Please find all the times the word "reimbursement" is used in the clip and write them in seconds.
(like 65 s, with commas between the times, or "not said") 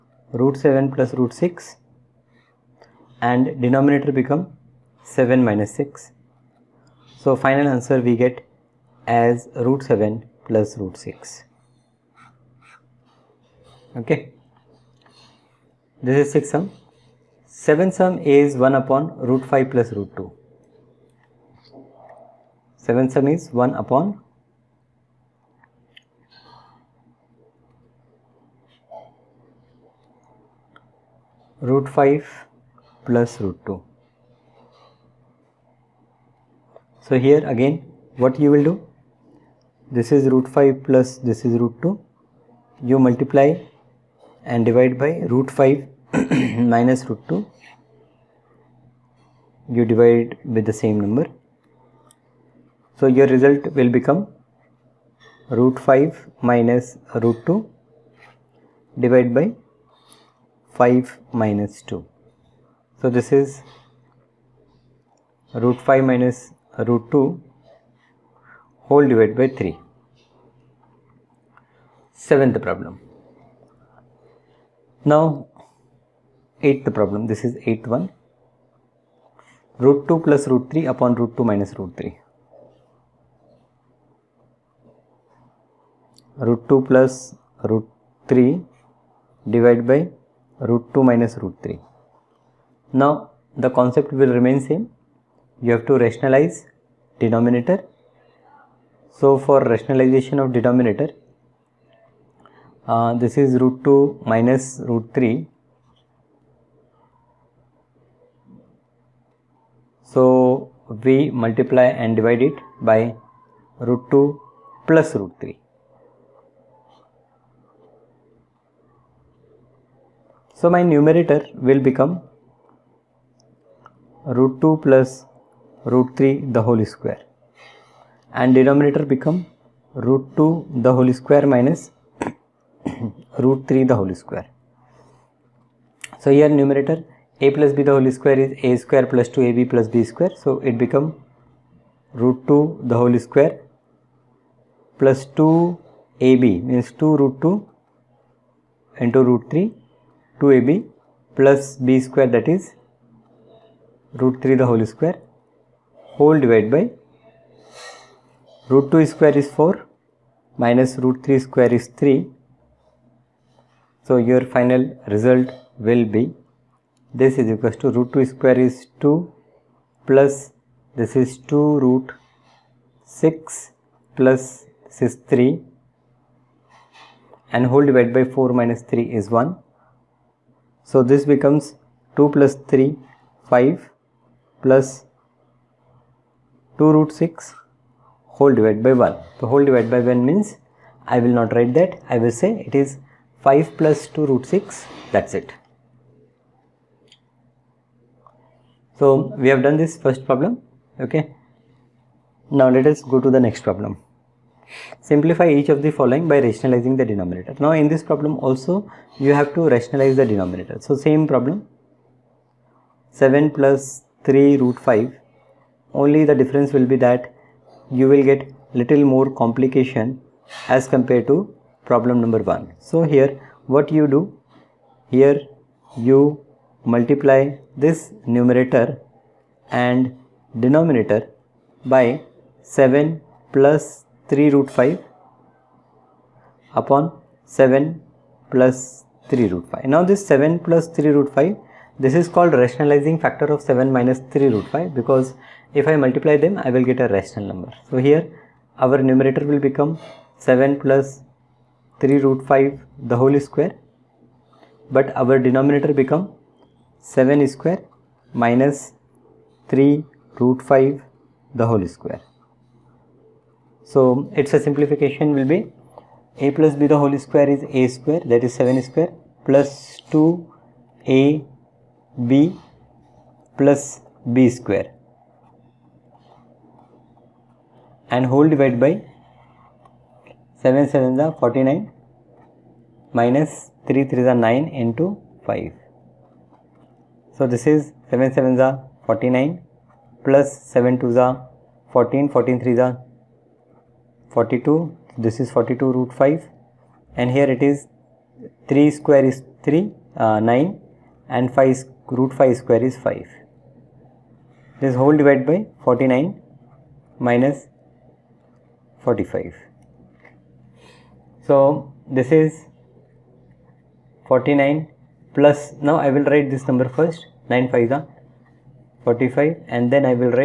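not said.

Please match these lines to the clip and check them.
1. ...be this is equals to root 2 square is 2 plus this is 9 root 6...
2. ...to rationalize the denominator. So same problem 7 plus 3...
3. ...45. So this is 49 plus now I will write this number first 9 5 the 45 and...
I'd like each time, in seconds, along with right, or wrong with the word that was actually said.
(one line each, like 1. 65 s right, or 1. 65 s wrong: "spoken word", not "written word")
1. 166 s wrong: "2", not "9"
2. 209 s right
3. 308 s right.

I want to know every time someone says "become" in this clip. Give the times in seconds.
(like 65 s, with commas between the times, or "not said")
4 s, 53 s, 121 s, 129 s, 140 s, 181 s, 249 s, 255 s.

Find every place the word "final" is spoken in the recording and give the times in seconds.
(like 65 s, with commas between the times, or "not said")
7 s, 164 s.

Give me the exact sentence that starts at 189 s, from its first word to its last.
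So whole divided by 1 means I will not write that.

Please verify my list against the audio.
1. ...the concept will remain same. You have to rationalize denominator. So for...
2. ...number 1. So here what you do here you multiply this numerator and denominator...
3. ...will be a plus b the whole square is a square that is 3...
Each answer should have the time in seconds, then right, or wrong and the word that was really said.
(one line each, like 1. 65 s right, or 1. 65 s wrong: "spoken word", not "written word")
1. 93 s right
2. 222 s right
3. 265 s wrong: "7", not "3".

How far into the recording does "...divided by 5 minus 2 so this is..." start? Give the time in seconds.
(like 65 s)
59 s.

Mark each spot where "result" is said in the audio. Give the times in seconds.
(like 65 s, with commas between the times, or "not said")
53 s, 165 s.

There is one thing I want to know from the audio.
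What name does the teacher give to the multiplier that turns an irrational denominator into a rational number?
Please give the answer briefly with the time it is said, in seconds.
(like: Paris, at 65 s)
rationalizing factor, at 242 s.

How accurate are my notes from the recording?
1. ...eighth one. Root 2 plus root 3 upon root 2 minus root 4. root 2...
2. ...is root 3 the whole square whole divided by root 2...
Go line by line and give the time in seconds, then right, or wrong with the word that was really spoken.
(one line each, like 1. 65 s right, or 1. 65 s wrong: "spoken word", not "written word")
1. 77 s wrong: "3", not "4"
2. 152 s right.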